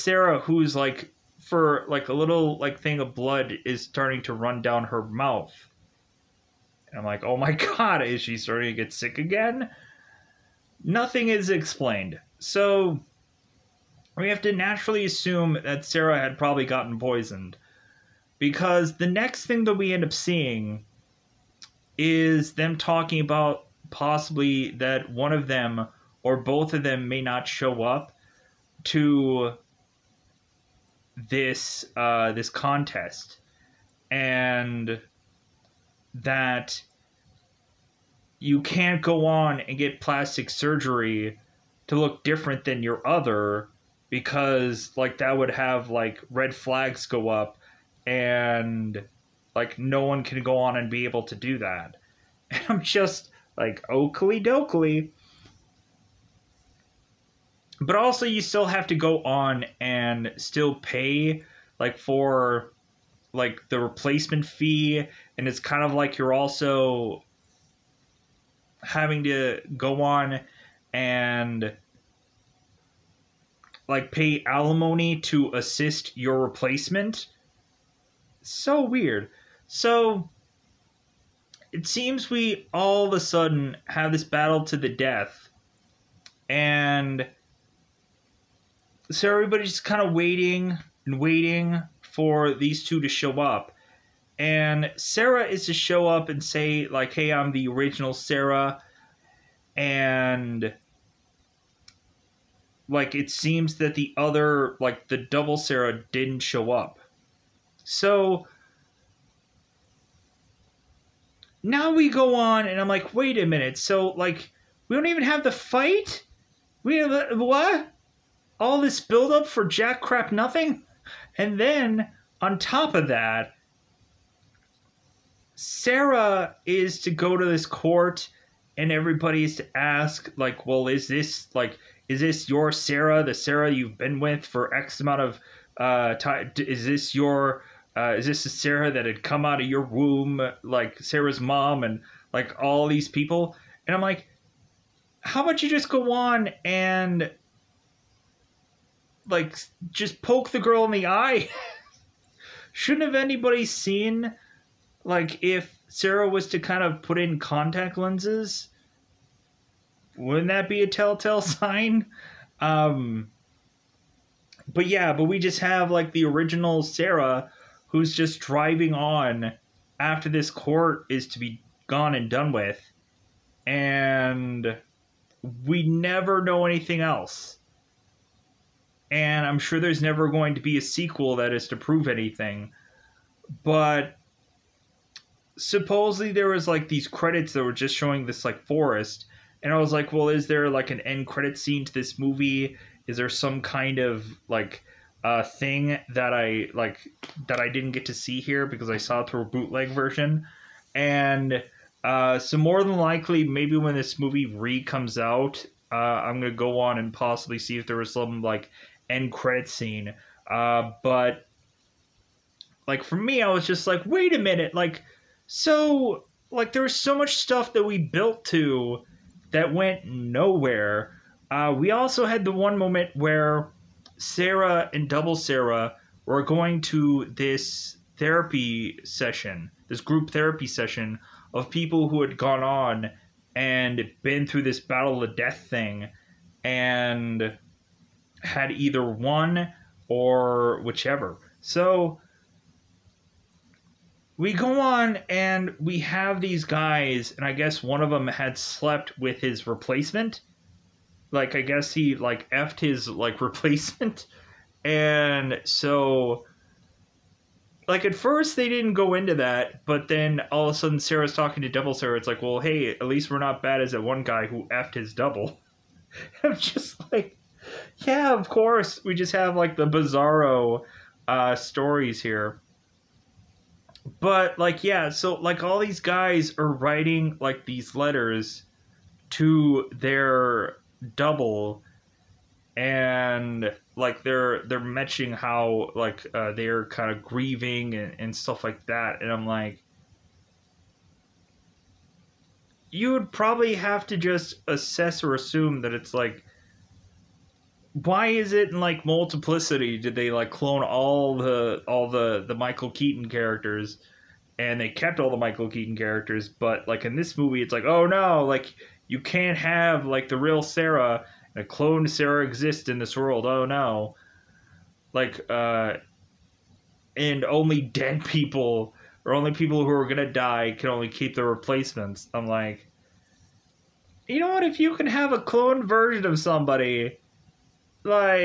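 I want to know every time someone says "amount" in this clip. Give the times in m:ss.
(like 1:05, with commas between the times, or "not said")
2:14.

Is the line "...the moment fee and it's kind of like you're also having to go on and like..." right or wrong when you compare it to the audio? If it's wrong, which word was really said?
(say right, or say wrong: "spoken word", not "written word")
wrong: "replacement", not "moment".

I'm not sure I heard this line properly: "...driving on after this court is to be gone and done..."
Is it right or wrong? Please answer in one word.
right.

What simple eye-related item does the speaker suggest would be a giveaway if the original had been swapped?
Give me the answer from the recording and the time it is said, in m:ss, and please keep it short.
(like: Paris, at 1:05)
contact lenses, at 2:37.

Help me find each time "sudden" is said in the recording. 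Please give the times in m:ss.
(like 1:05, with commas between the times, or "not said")
1:23, 4:20.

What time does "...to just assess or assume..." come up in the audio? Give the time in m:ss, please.
4:54.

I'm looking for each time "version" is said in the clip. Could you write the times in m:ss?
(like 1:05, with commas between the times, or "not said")
3:19, 5:25.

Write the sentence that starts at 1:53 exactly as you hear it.
So, like, we don't even have the fight?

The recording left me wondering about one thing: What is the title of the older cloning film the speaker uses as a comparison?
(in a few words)
Multiplicity.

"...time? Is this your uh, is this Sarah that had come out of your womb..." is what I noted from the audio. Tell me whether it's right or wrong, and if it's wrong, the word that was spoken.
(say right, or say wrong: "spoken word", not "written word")
right.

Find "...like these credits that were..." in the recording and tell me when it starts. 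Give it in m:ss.
3:06.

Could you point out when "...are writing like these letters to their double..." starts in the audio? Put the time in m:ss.
4:36.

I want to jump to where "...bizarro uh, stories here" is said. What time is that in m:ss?
4:29.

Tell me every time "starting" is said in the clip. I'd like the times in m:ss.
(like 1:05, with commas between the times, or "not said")
0:03, 0:08.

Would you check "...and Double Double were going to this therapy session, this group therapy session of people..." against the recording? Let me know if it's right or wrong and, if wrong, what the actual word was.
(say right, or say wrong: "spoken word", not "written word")
wrong: "Sarah", not "Double".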